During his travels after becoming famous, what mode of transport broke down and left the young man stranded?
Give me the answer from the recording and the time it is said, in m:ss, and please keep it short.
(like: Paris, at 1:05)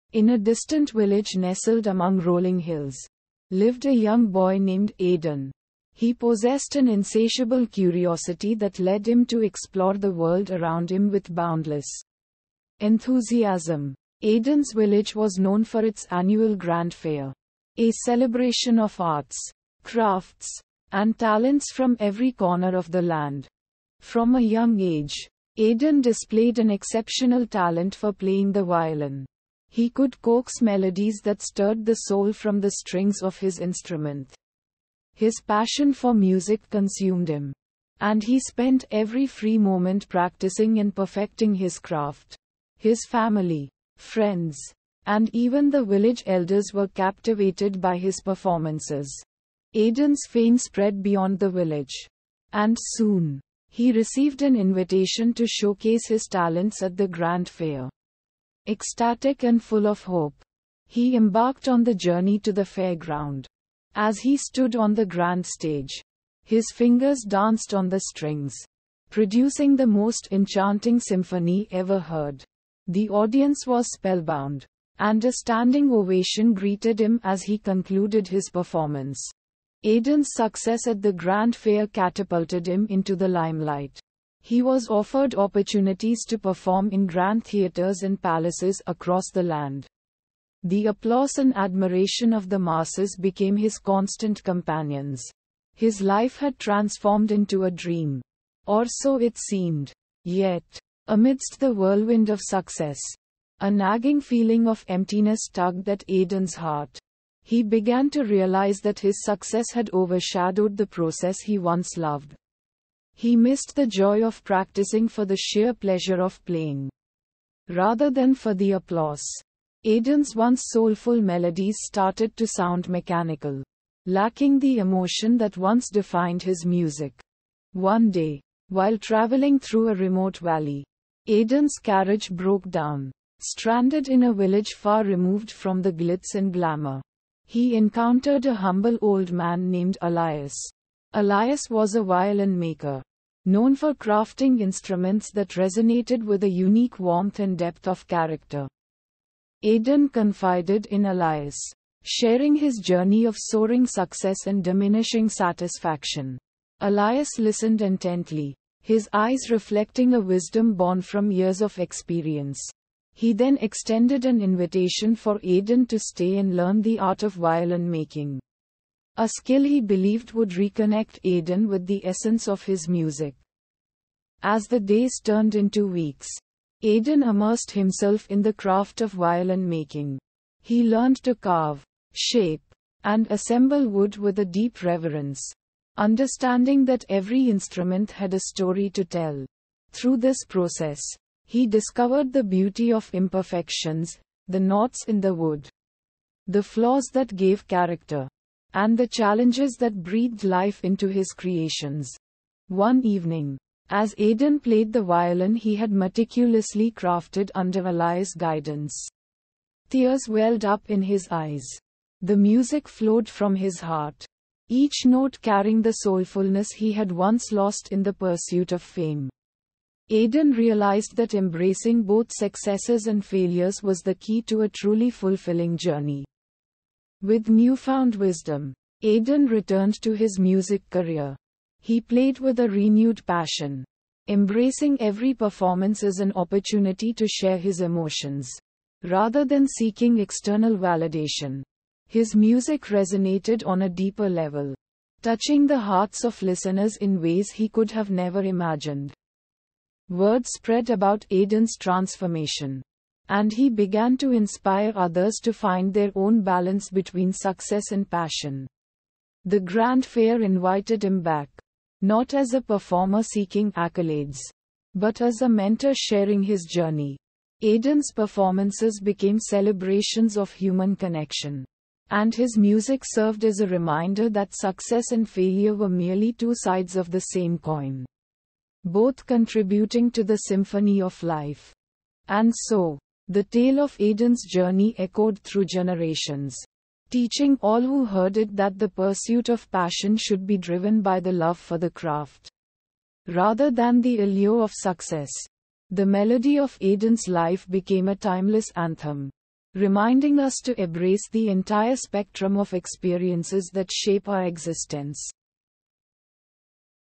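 carriage, at 2:11.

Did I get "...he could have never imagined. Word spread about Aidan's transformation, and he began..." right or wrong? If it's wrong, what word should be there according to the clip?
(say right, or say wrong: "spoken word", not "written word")
right.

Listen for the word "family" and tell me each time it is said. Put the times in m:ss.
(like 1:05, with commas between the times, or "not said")
0:43.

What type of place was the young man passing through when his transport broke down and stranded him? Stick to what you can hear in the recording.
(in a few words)
remote valley.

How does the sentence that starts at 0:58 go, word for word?
Ecstatic and full of hope, he embarked on the journey to the fairground.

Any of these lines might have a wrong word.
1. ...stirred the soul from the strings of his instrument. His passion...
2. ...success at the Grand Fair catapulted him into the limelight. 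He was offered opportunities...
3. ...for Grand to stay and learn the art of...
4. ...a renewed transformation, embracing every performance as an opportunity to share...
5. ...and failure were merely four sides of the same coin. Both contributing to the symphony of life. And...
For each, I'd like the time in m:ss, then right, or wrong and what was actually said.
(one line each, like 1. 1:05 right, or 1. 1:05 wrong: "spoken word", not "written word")
1. 0:31 right
2. 1:20 right
3. 2:45 wrong: "Aidan", not "Grand"
4. 3:52 wrong: "passion", not "transformation"
5. 4:35 wrong: "two", not "four".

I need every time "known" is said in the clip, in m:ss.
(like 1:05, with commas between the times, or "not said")
0:15, 2:23.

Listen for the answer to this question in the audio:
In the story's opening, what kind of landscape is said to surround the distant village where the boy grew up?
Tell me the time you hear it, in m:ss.
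0:02.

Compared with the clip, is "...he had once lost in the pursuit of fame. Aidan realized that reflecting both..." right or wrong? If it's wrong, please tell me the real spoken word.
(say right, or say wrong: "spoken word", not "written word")
wrong: "embracing", not "reflecting".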